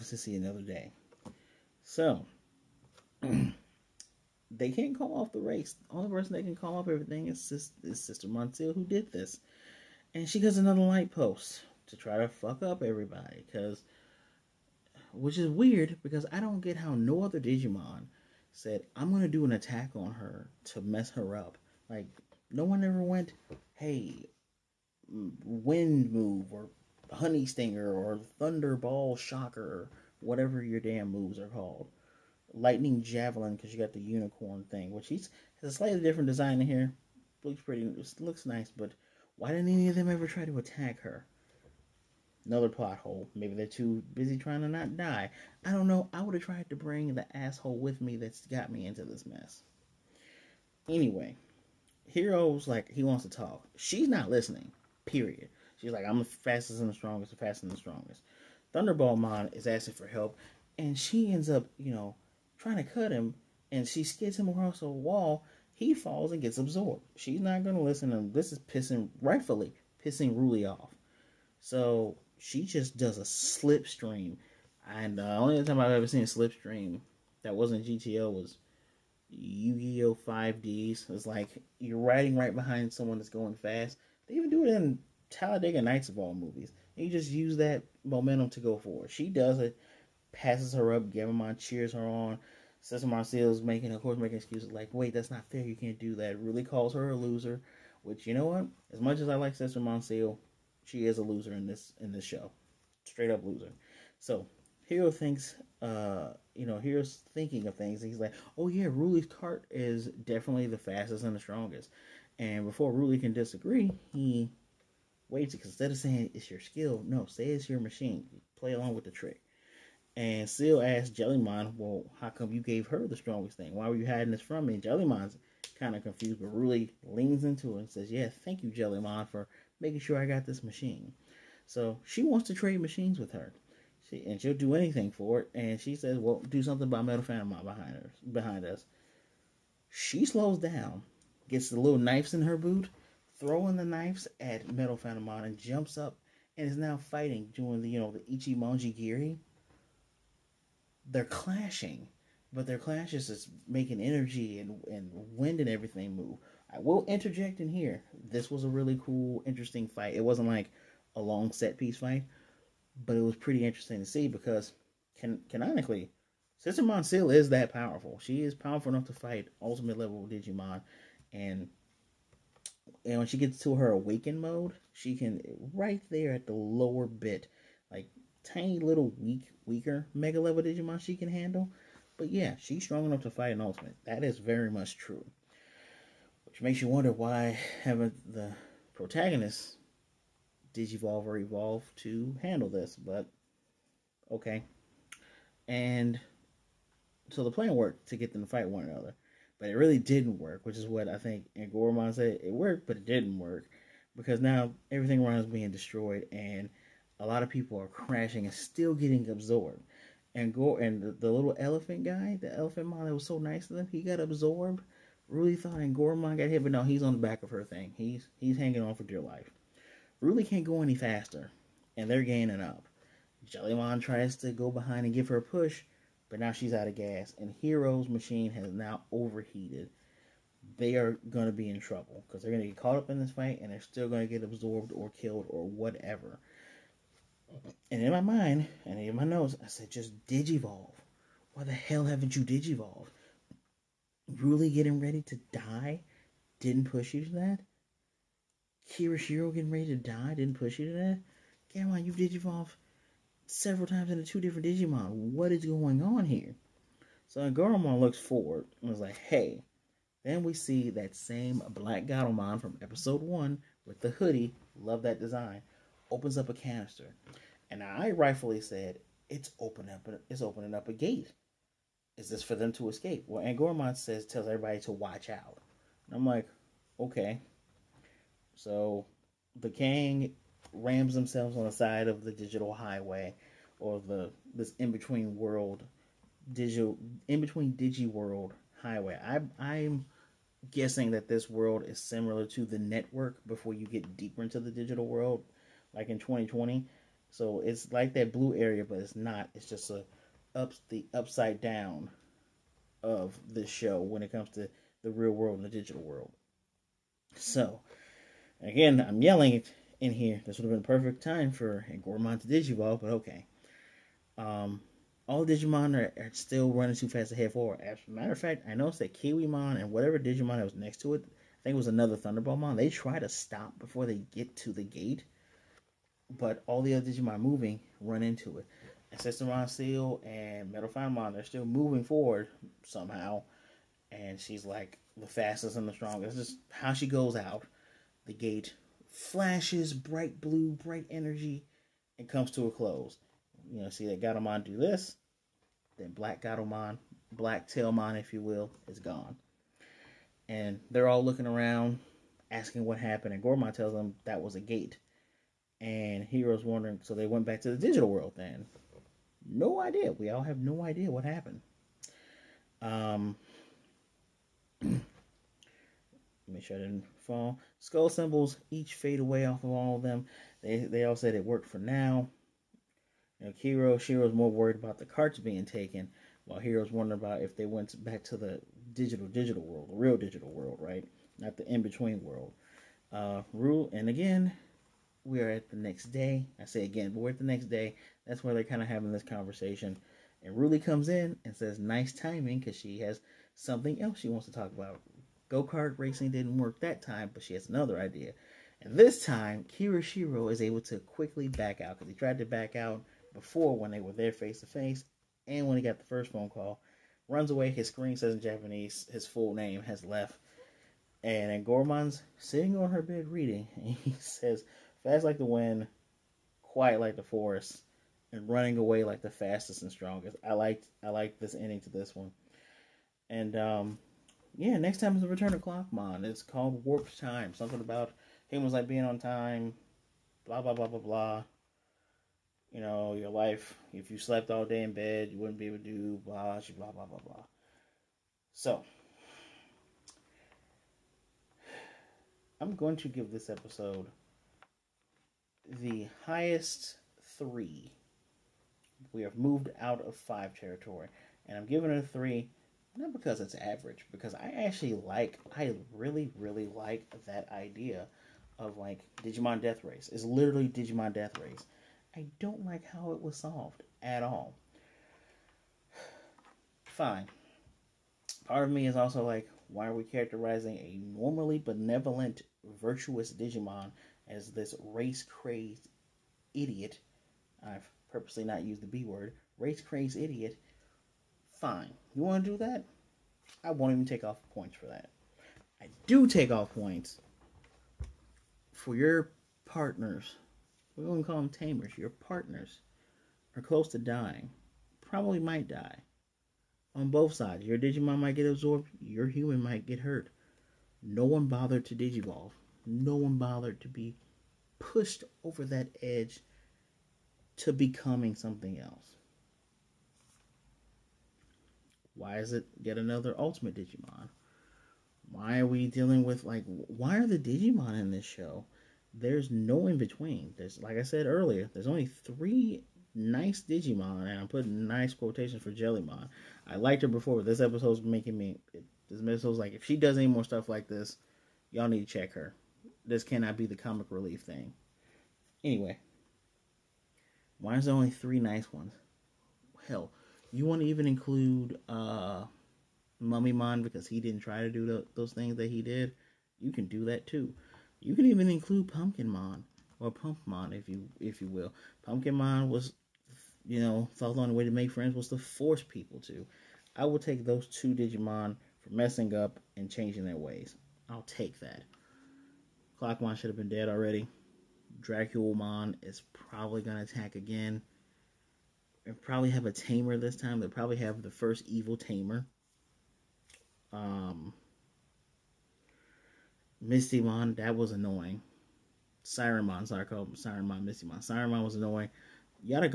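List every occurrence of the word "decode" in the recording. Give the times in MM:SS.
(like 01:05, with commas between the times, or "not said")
not said.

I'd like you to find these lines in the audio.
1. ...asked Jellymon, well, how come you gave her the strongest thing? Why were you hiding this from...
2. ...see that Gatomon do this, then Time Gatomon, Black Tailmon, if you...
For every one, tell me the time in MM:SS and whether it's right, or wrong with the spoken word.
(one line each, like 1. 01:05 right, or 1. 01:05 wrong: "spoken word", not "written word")
1. 02:00 right
2. 05:43 wrong: "Black", not "Time".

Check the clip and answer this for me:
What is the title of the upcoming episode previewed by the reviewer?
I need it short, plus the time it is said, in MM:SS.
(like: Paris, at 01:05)
Warped Time, at 07:06.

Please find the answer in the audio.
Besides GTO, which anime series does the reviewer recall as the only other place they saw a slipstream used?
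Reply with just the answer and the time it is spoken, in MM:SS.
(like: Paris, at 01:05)
Yu Gi Oh! 5Ds, at 01:19.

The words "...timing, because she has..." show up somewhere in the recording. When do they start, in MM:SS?
06:32.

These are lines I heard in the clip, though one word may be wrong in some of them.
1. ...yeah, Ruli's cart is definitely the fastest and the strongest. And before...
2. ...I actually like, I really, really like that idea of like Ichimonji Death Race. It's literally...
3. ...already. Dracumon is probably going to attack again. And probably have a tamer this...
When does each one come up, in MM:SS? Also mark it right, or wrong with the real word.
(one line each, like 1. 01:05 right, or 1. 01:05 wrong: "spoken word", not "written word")
1. 01:48 right
2. 07:34 wrong: "Digimon", not "Ichimonji"
3. 09:23 right.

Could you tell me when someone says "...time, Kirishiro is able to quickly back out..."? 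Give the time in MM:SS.
06:39.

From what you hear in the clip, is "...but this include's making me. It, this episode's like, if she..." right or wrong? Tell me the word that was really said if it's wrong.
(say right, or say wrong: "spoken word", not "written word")
wrong: "episode", not "include".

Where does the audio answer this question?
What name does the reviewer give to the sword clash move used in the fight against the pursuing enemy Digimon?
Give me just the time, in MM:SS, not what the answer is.
02:28.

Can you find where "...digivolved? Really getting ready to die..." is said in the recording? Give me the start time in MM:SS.
04:02.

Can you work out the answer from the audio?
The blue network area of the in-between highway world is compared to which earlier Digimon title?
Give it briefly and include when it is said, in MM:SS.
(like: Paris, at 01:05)
2020, at 04:56.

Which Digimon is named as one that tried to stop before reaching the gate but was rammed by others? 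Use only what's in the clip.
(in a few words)
Kiwimon.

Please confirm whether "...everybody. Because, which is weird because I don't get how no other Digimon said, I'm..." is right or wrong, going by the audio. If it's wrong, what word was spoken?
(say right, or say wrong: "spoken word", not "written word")
right.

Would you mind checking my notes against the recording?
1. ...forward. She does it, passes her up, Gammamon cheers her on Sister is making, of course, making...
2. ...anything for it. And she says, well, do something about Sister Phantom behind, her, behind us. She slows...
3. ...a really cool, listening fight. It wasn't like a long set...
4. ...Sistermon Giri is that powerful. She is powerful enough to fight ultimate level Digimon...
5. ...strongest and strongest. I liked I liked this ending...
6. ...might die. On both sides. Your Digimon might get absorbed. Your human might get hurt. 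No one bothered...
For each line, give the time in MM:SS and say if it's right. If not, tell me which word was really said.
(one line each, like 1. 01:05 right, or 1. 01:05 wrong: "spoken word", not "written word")
1. 01:28 right
2. 02:14 wrong: "Metal", not "Sister"
3. 02:38 wrong: "interesting", not "listening"
4. 02:46 wrong: "Ciel", not "Giri"
5. 06:59 wrong: "fastest", not "strongest"
6. 08:15 right.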